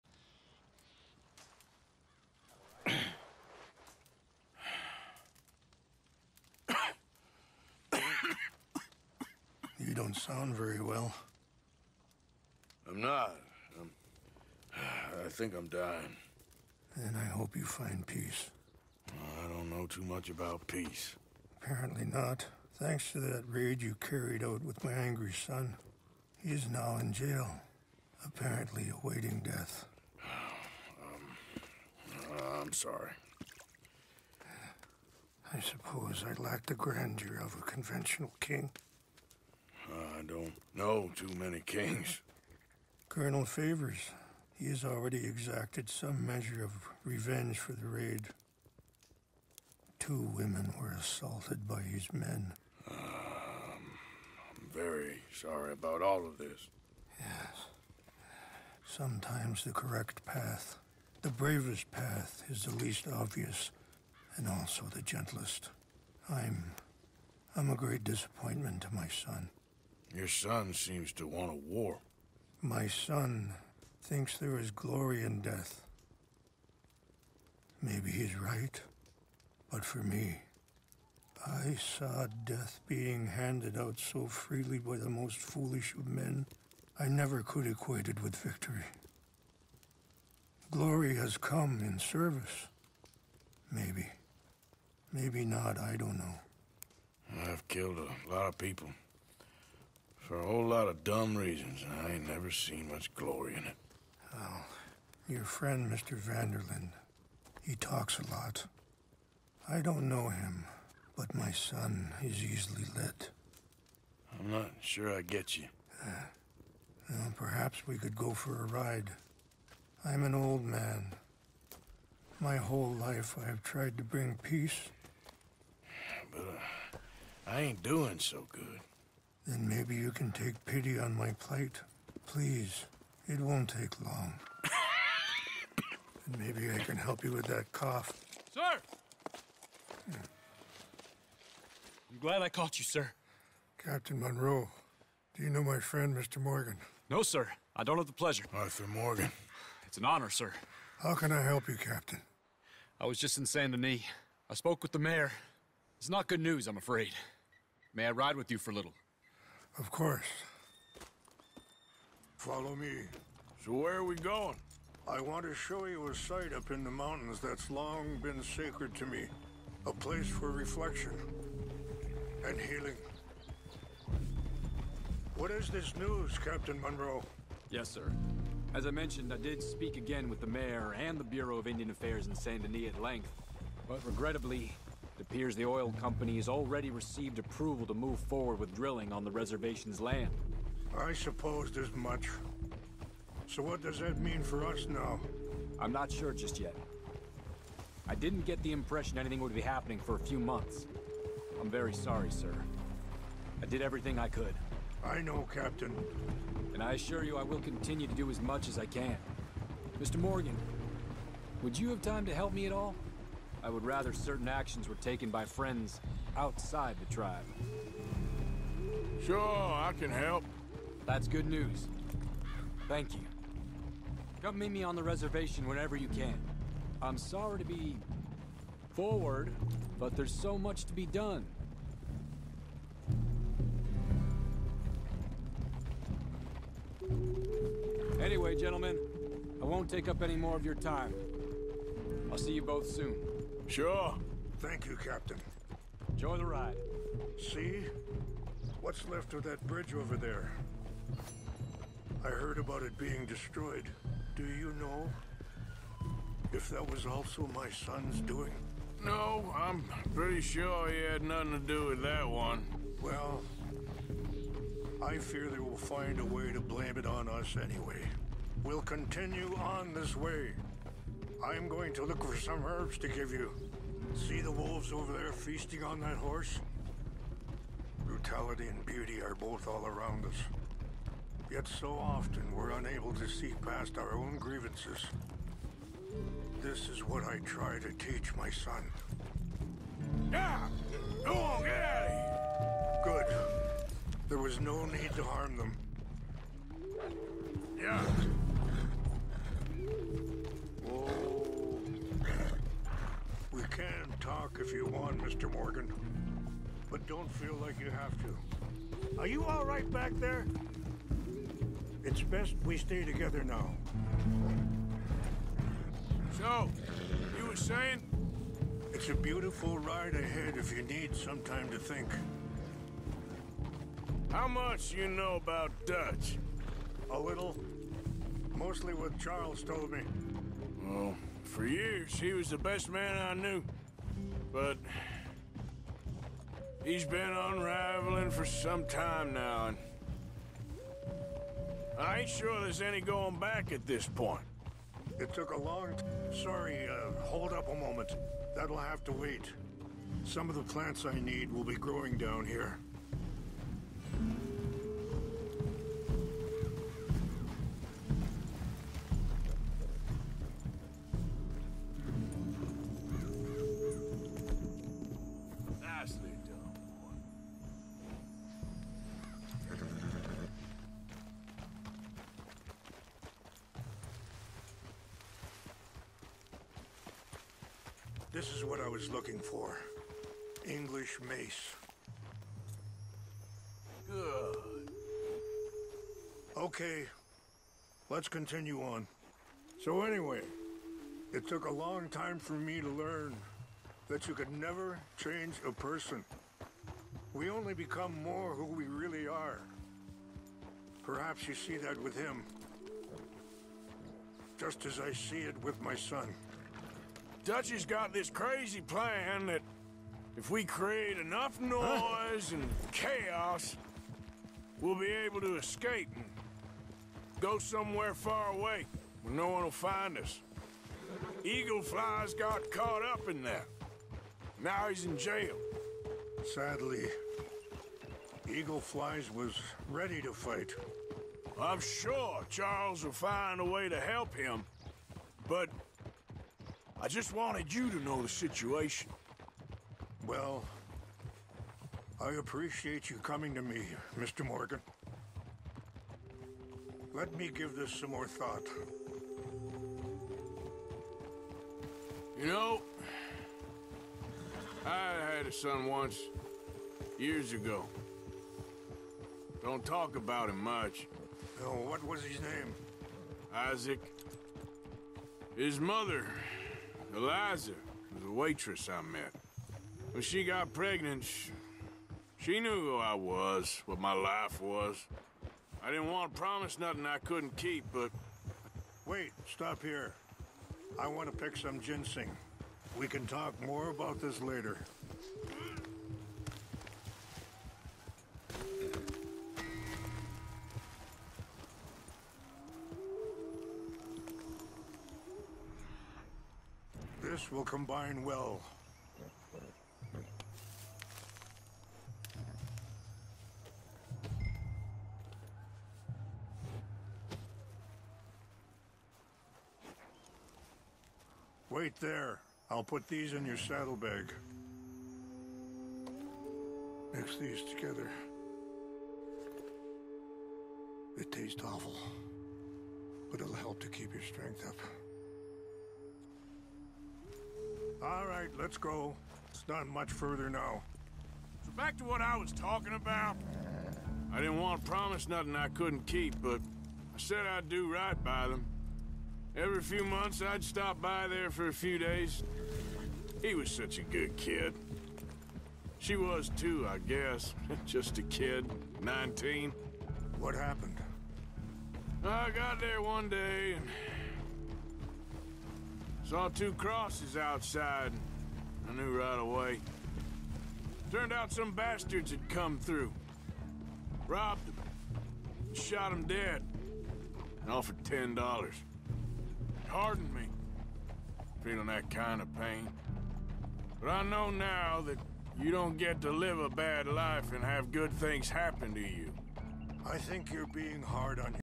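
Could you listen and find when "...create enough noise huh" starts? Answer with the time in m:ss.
6:50.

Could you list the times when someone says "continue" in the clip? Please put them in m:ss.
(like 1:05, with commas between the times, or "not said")
3:27, 4:28, 6:28.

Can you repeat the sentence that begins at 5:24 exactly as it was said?
How much you know about Dutch?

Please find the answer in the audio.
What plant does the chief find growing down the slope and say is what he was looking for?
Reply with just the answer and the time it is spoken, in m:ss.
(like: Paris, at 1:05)
English mace, at 6:20.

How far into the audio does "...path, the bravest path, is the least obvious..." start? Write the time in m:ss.
1:00.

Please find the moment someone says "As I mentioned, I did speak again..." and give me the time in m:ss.
2:58.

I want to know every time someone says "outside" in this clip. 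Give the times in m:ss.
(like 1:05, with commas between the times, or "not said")
3:36, 9:17.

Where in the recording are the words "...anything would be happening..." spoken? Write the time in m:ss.
3:19.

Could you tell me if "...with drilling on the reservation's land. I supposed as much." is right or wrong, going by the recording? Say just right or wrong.
right.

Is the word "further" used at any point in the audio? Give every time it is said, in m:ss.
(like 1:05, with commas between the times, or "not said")
8:50.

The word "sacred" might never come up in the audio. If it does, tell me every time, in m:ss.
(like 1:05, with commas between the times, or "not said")
2:48.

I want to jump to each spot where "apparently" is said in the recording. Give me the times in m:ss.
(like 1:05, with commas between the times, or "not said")
0:21, 0:28.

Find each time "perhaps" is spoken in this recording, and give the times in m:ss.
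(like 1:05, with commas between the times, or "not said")
1:57, 6:41.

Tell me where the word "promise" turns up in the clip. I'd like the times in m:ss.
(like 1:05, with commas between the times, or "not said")
7:56, 8:54.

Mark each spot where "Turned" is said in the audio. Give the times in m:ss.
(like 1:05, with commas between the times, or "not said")
9:21.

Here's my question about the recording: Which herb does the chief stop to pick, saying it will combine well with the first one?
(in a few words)
ginseng.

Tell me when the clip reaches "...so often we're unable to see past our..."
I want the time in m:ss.
4:41.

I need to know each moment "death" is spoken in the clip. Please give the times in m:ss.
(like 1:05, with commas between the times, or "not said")
0:29, 1:15, 1:22.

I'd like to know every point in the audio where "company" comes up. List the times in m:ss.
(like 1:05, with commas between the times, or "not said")
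3:06.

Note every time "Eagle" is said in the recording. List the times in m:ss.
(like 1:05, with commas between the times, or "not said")
7:01, 7:08.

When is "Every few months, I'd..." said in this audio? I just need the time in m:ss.
8:59.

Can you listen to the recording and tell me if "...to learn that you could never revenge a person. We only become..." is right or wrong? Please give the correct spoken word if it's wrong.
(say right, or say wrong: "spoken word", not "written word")
wrong: "change", not "revenge".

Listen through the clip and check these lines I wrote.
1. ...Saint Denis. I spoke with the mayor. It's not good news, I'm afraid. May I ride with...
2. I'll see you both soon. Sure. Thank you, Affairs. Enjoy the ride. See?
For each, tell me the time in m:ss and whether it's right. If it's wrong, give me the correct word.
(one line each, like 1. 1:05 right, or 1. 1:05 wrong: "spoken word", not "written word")
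1. 2:33 right
2. 4:02 wrong: "Captain", not "Affairs".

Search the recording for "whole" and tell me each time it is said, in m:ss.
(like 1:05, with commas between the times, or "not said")
1:40, 2:02.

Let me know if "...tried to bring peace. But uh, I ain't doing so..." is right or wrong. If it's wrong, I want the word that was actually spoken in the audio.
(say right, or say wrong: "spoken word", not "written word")
right.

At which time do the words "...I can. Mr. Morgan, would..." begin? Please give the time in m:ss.
3:28.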